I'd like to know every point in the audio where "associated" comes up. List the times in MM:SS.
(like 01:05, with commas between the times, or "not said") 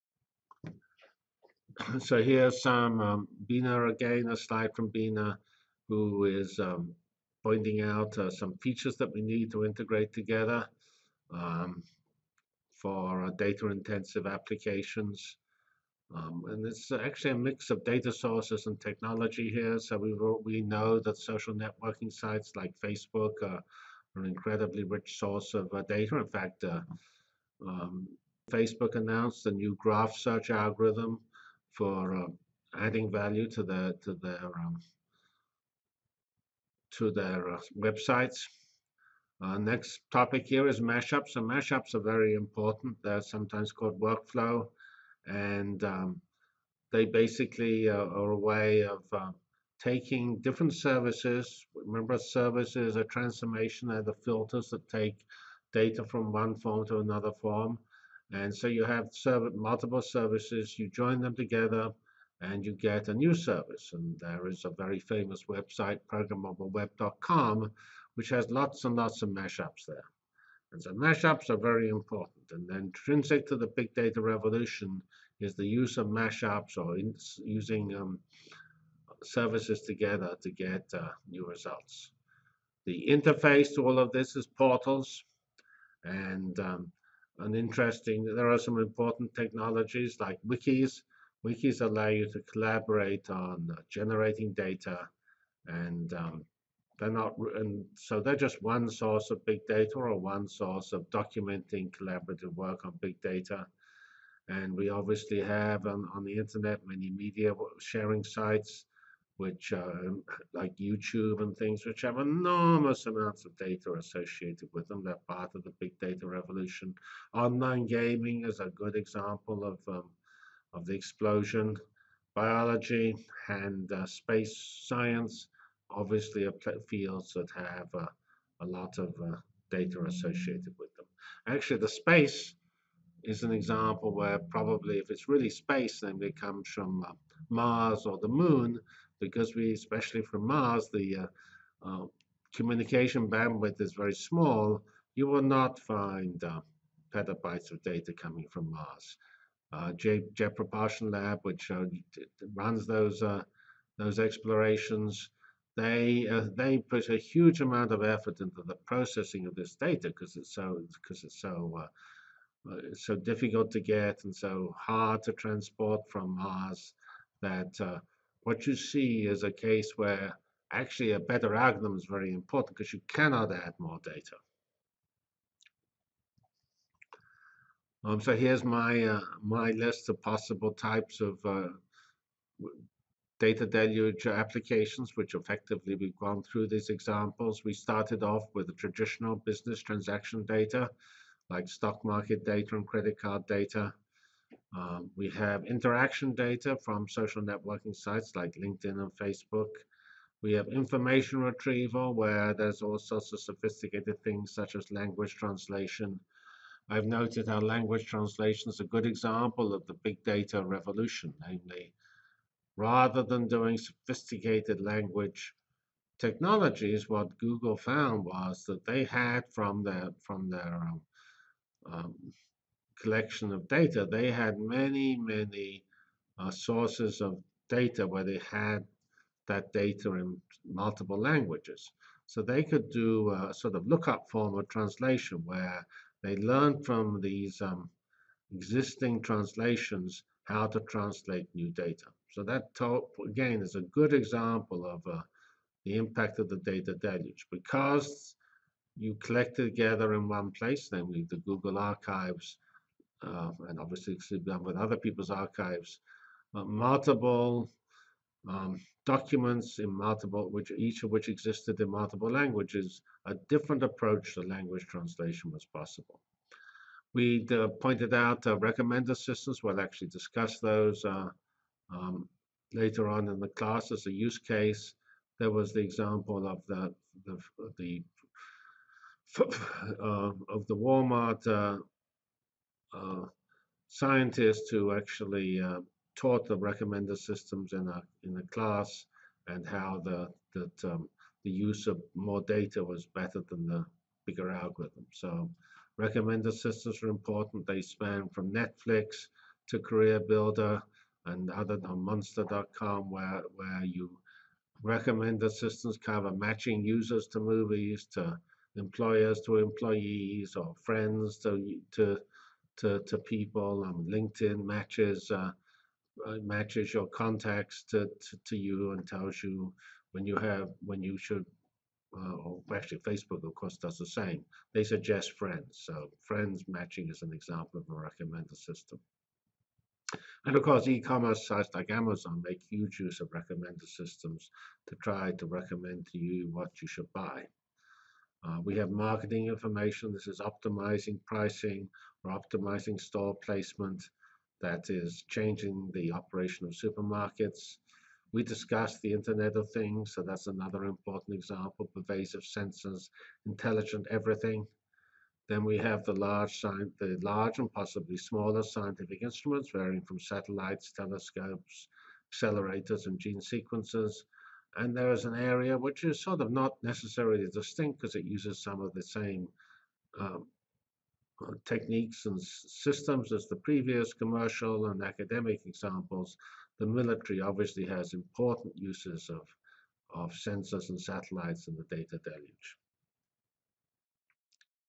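01:53, 02:10.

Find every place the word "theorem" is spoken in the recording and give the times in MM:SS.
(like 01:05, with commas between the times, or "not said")
not said.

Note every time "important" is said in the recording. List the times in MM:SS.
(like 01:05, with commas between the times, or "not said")
00:42, 01:11, 01:28, 02:52, 04:57, 05:50, 06:18.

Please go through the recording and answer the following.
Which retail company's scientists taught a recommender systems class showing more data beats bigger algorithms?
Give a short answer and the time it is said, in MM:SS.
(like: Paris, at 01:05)
Walmart, at 04:40.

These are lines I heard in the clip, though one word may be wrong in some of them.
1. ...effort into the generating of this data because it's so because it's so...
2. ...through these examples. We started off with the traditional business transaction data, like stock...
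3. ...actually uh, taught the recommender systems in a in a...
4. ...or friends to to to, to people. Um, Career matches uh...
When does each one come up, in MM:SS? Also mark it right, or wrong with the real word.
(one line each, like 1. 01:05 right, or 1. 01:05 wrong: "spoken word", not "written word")
1. 02:38 wrong: "processing", not "generating"
2. 03:06 right
3. 04:44 right
4. 05:10 wrong: "LinkedIn", not "Career".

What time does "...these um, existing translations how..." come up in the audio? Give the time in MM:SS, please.
03:57.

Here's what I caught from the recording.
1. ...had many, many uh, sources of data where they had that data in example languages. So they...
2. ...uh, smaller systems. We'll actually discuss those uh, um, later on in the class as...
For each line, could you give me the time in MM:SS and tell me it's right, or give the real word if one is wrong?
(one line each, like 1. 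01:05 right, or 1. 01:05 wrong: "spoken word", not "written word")
1. 03:44 wrong: "multiple", not "example"
2. 04:28 wrong: "recommender", not "smaller".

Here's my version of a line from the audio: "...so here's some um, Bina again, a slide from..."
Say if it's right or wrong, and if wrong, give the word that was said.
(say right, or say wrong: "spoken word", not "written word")
right.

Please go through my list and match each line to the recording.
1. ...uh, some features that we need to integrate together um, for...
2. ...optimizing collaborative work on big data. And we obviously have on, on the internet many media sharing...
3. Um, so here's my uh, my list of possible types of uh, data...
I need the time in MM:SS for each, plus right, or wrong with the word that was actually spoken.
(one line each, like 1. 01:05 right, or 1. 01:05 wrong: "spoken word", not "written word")
1. 00:08 right
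2. 01:41 wrong: "documenting", not "optimizing"
3. 02:58 right.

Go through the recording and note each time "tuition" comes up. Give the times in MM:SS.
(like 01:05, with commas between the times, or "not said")
not said.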